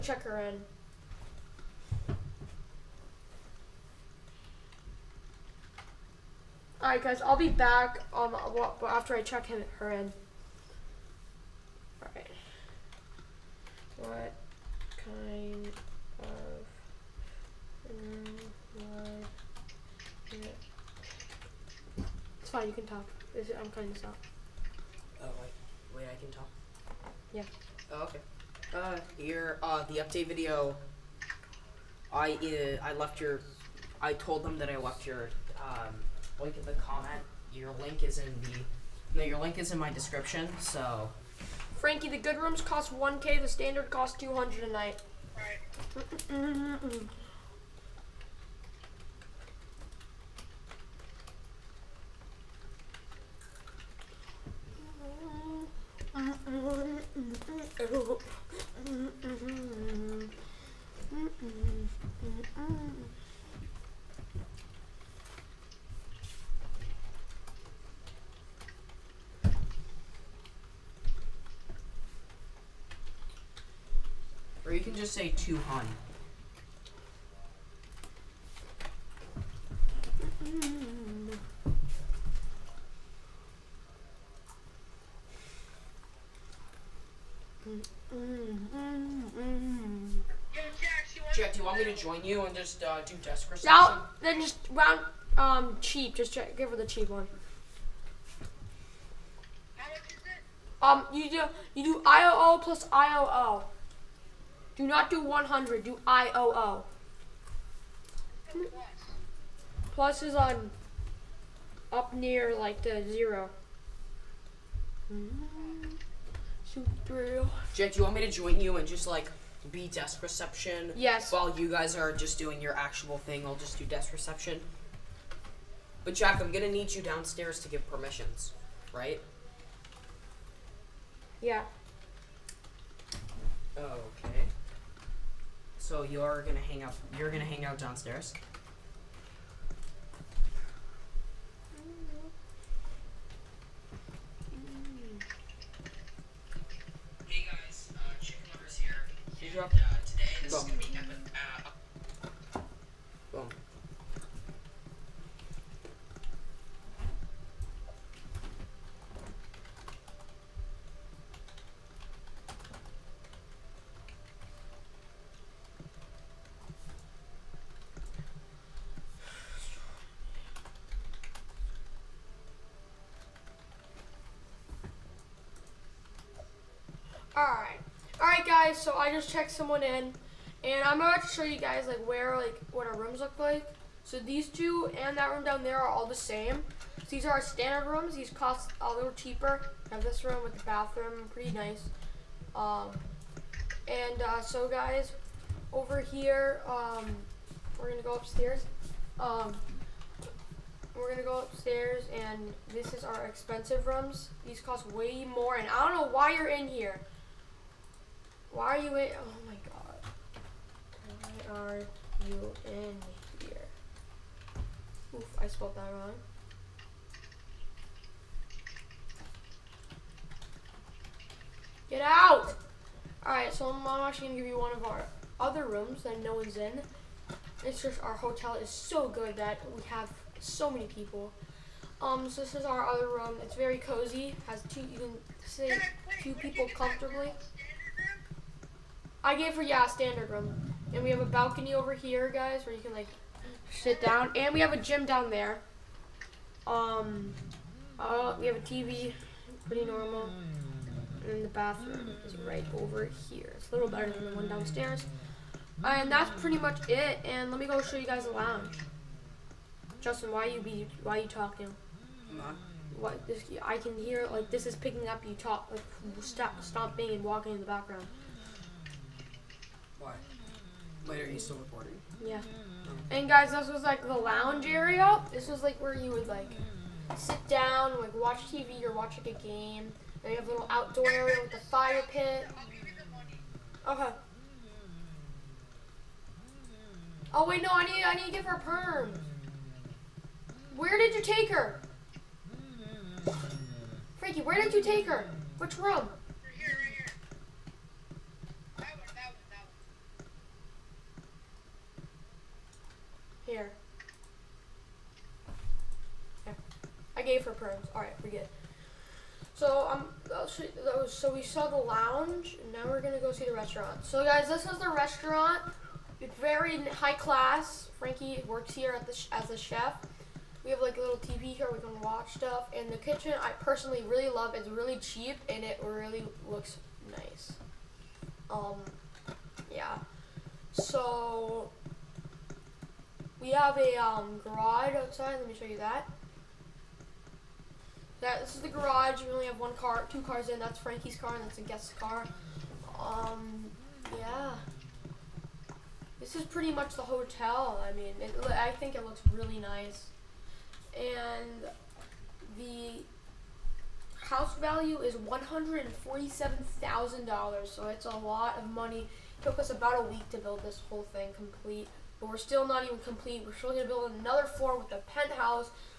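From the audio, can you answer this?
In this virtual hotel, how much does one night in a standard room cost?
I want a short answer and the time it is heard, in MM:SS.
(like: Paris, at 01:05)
200, at 00:44.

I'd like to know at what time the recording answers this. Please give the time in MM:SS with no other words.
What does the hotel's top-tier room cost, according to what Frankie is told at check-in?
00:42.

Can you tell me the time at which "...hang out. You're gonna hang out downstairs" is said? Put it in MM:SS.
02:16.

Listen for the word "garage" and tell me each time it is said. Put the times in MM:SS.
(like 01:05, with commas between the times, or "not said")
05:34, 05:38.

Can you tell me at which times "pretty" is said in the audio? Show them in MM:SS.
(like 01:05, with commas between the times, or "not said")
03:11, 04:09, 04:16, 05:46.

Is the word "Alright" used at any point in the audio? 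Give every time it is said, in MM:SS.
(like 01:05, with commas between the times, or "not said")
00:06, 00:14, 03:43.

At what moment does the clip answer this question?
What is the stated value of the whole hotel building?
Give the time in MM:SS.
05:55.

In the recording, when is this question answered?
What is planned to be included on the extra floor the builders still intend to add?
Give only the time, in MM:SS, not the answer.
06:05.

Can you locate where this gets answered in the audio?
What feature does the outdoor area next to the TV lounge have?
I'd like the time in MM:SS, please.
04:41.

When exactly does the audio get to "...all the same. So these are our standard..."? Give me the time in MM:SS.
03:05.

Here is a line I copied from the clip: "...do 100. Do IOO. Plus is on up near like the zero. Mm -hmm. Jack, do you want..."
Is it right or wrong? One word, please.
right.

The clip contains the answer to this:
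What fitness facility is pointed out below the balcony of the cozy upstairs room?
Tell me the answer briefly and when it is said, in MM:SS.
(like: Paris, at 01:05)
gym, at 04:04.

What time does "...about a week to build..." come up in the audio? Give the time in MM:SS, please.
05:59.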